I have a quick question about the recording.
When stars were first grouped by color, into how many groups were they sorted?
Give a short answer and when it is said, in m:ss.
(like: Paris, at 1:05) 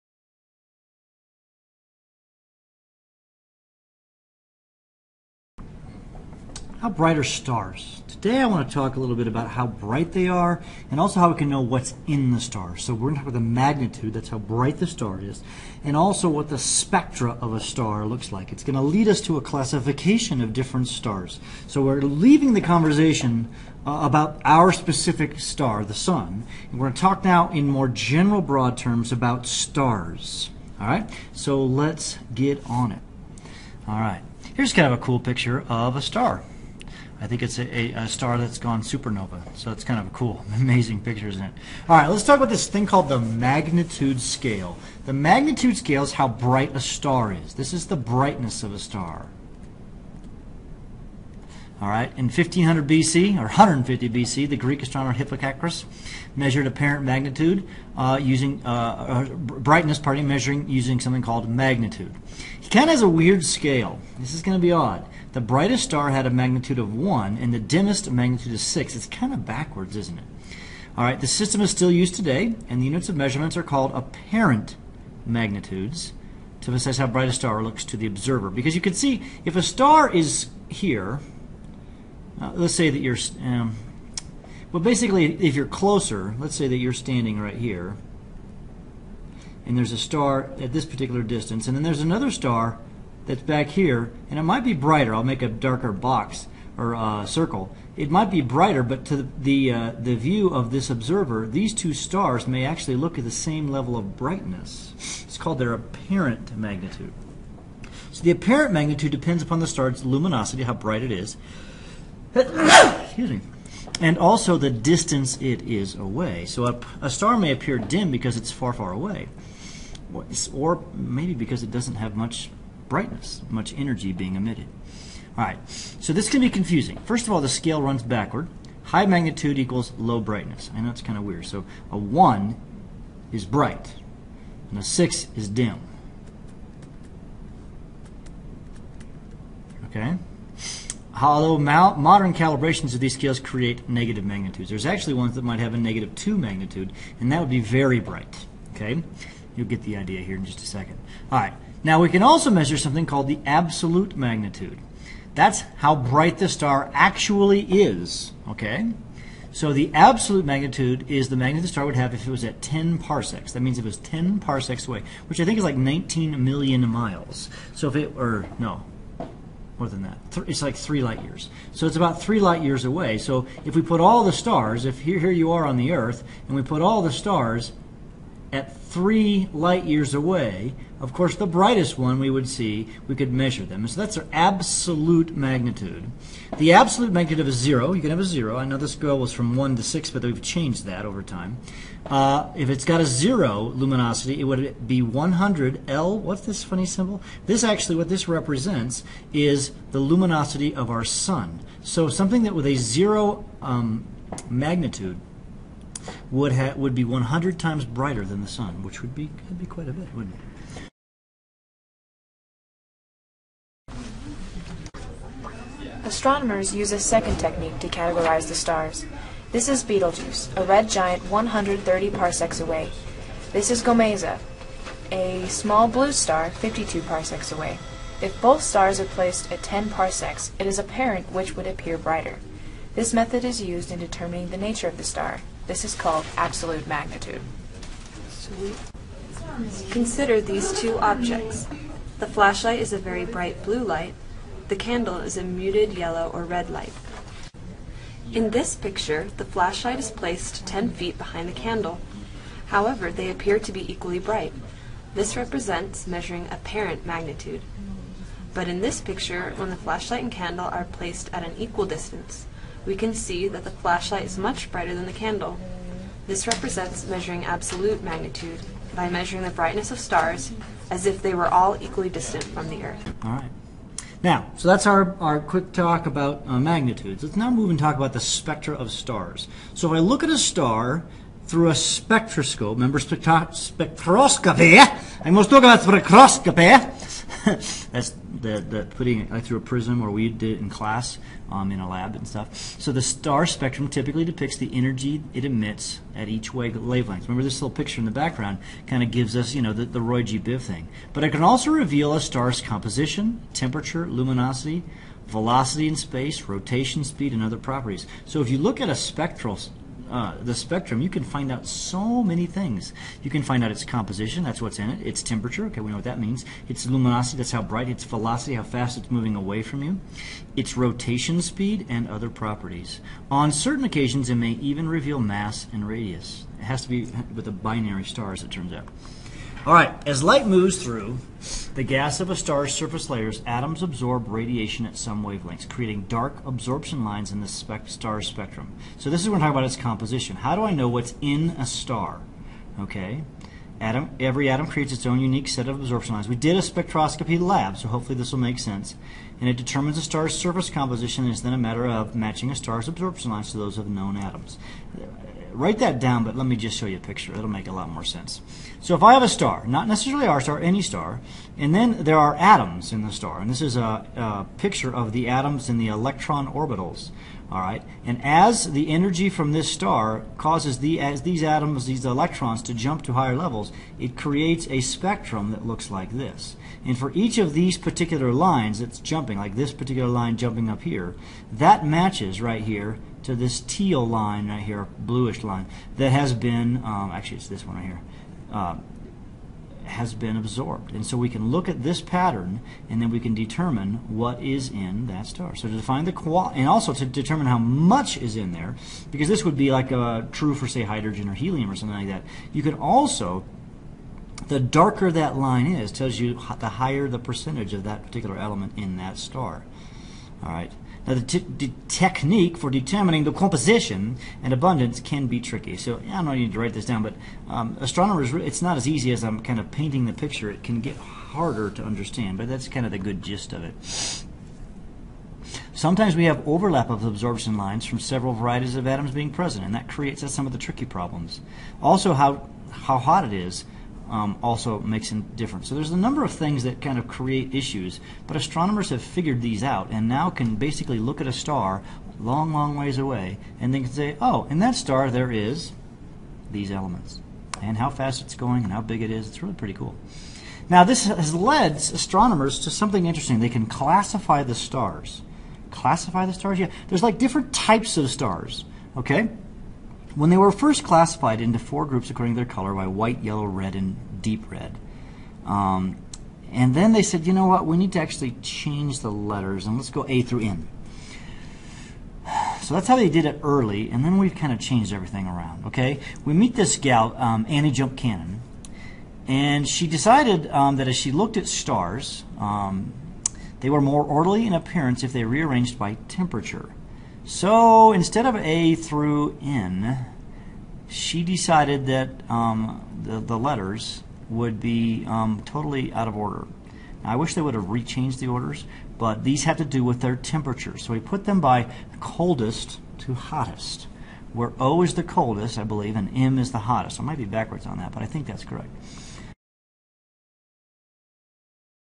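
4, at 7:41.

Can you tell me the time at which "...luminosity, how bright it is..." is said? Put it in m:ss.
1:50.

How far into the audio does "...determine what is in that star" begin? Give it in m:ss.
6:33.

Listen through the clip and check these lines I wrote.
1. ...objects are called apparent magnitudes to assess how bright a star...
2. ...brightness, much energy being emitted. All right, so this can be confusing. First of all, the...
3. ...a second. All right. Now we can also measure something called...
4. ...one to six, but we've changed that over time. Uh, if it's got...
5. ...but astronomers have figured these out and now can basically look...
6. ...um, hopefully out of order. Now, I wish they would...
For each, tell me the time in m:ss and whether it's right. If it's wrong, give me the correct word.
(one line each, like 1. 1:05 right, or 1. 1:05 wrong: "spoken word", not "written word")
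1. 1:13 wrong: "measurements", not "objects"
2. 2:02 right
3. 2:30 right
4. 3:09 right
5. 7:18 right
6. 8:15 wrong: "totally", not "hopefully".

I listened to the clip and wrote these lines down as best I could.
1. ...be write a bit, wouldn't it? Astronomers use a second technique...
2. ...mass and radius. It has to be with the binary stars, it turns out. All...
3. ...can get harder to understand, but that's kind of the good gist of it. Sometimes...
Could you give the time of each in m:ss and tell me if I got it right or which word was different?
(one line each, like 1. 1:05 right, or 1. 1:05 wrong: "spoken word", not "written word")
1. 3:29 wrong: "quite", not "write"
2. 5:25 right
3. 7:00 right.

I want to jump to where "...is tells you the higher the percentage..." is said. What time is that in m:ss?
6:45.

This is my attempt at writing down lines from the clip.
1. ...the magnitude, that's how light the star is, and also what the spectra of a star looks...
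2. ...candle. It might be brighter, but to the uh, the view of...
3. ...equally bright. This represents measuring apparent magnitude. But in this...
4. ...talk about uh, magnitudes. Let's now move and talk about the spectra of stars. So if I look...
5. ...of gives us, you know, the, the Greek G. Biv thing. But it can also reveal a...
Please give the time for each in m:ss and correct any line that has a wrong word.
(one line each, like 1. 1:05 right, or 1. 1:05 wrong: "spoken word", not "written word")
1. 0:13 wrong: "bright", not "light"
2. 1:37 wrong: "circle", not "candle"
3. 4:13 right
4. 4:35 right
5. 4:59 wrong: "Roy", not "Greek".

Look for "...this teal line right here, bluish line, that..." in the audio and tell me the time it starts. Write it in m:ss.
6:23.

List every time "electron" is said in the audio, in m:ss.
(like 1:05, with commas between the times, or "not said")
6:05, 6:12.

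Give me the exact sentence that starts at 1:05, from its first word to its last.
The brightest star had a magnitude of one, and the dimmest a magnitude of six.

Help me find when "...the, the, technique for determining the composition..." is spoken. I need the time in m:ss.
6:51.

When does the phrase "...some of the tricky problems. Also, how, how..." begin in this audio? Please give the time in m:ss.
7:10.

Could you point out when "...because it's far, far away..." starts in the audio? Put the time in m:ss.
1:58.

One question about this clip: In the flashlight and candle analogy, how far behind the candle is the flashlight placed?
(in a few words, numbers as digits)
10 feet.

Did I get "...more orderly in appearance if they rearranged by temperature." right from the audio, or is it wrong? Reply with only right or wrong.
right.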